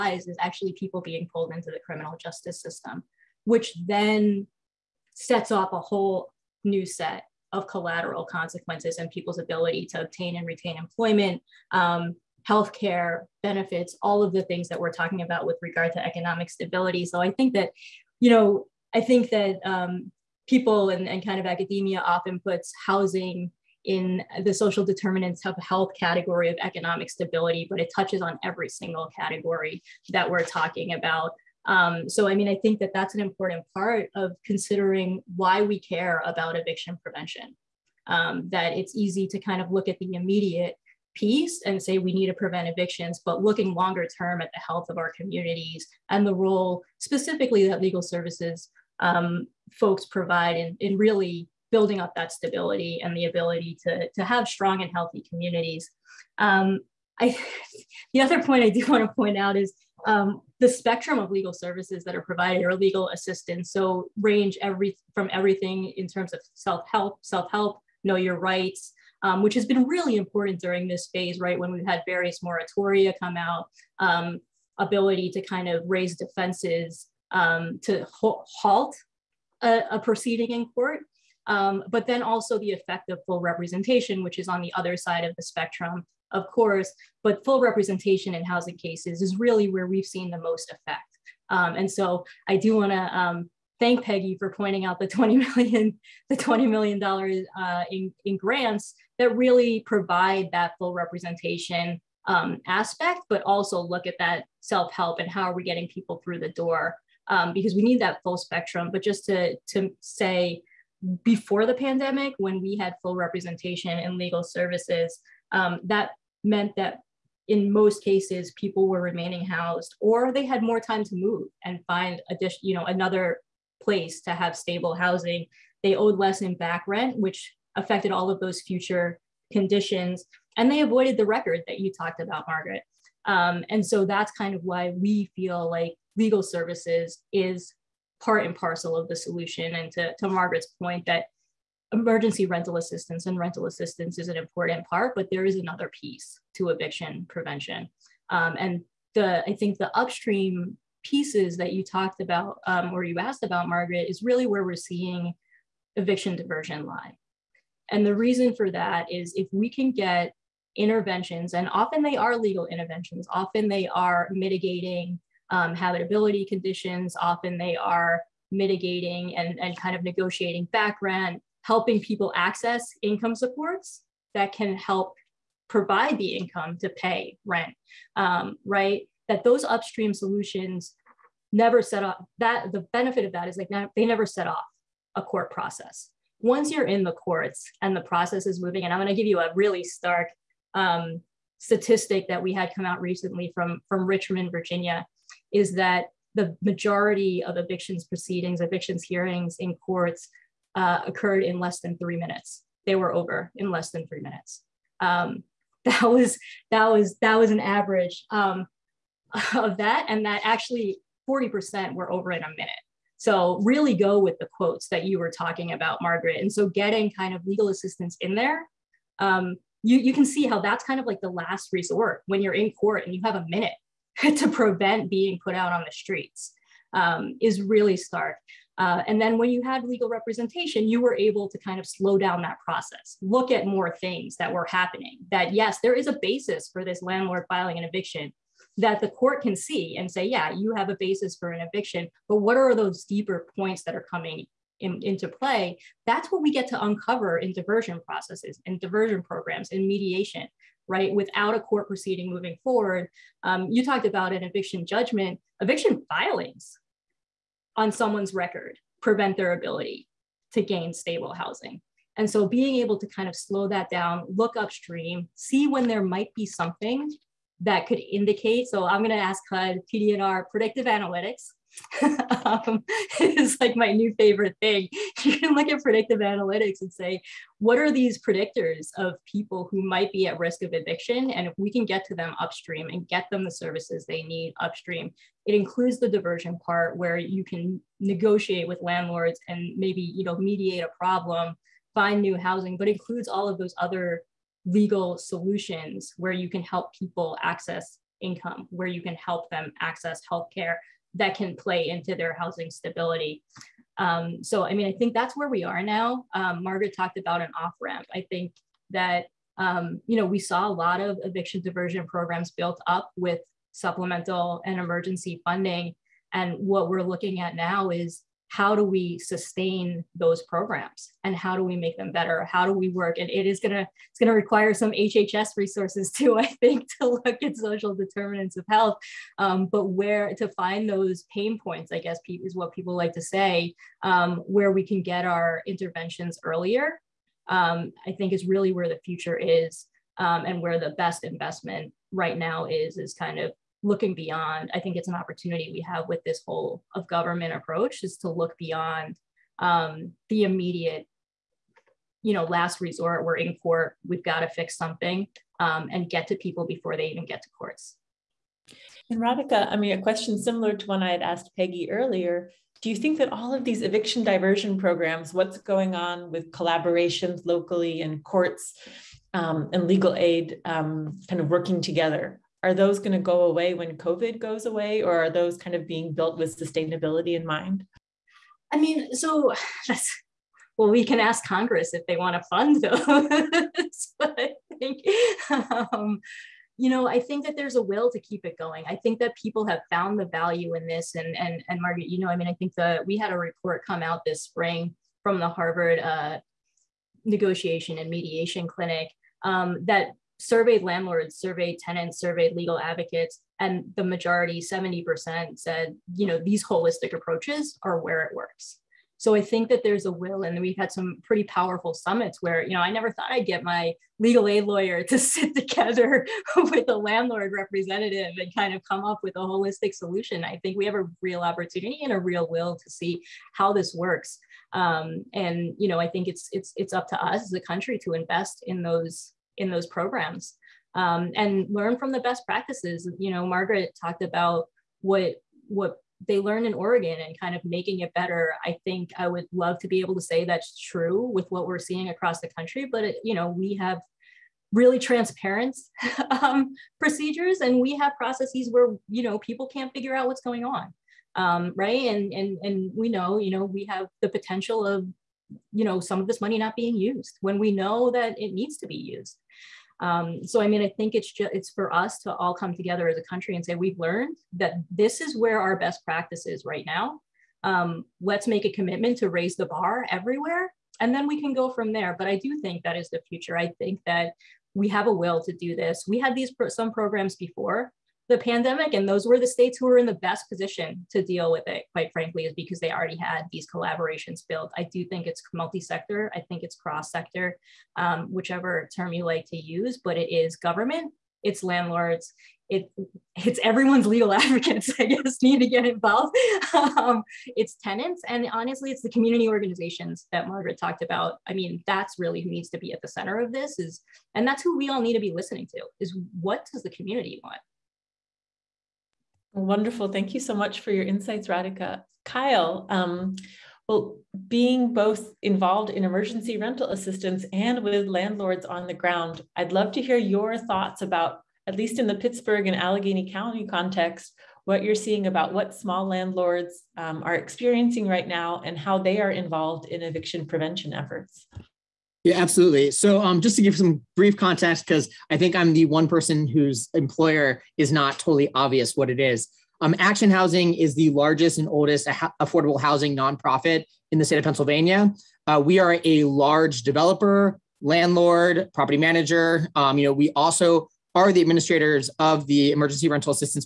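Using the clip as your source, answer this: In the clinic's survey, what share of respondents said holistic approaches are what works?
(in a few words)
70%.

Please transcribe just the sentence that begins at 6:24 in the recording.
but I think, um, you know, I think that there's a will to keep it going.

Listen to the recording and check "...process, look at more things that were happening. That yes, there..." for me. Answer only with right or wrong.
right.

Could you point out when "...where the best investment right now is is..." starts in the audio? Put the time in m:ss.
5:40.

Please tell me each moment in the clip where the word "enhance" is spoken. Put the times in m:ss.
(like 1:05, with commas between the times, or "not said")
not said.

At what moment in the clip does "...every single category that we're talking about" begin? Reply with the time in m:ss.
0:28.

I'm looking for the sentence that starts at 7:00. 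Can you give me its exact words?
I think we have a real opportunity and a real will to see how this works.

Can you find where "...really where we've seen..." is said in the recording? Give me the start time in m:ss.
1:29.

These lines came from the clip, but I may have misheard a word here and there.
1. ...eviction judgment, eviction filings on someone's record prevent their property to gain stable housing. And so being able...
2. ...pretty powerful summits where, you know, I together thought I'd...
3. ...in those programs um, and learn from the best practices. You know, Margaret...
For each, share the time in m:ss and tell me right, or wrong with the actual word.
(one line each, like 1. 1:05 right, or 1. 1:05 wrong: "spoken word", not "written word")
1. 4:14 wrong: "ability", not "property"
2. 6:51 wrong: "never", not "together"
3. 7:09 right.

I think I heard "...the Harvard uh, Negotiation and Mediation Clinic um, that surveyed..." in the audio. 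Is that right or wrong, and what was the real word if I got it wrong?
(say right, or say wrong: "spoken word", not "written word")
right.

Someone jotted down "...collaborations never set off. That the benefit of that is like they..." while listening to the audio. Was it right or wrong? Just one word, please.
wrong.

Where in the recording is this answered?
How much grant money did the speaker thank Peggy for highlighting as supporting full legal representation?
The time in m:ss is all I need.
1:36.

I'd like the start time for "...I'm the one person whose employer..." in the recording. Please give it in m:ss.
8:55.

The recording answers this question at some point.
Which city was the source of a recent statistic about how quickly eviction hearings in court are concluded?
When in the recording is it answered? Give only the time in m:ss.
3:14.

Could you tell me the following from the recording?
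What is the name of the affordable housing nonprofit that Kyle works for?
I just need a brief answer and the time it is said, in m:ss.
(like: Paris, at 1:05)
Action Housing, at 8:59.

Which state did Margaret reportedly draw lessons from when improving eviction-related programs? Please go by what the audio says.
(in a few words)
Oregon.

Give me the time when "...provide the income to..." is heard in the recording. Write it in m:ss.
2:55.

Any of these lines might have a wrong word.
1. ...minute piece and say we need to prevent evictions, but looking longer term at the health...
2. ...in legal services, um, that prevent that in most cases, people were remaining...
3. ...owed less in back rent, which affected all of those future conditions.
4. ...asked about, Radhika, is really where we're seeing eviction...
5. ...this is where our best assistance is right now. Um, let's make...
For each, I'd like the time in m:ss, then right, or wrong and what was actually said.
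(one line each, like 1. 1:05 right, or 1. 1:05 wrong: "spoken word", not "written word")
1. 0:40 wrong: "immediate", not "minute"
2. 1:53 wrong: "meant", not "prevent"
3. 2:05 right
4. 2:33 wrong: "Margaret", not "Radhika"
5. 7:44 wrong: "practice", not "assistance".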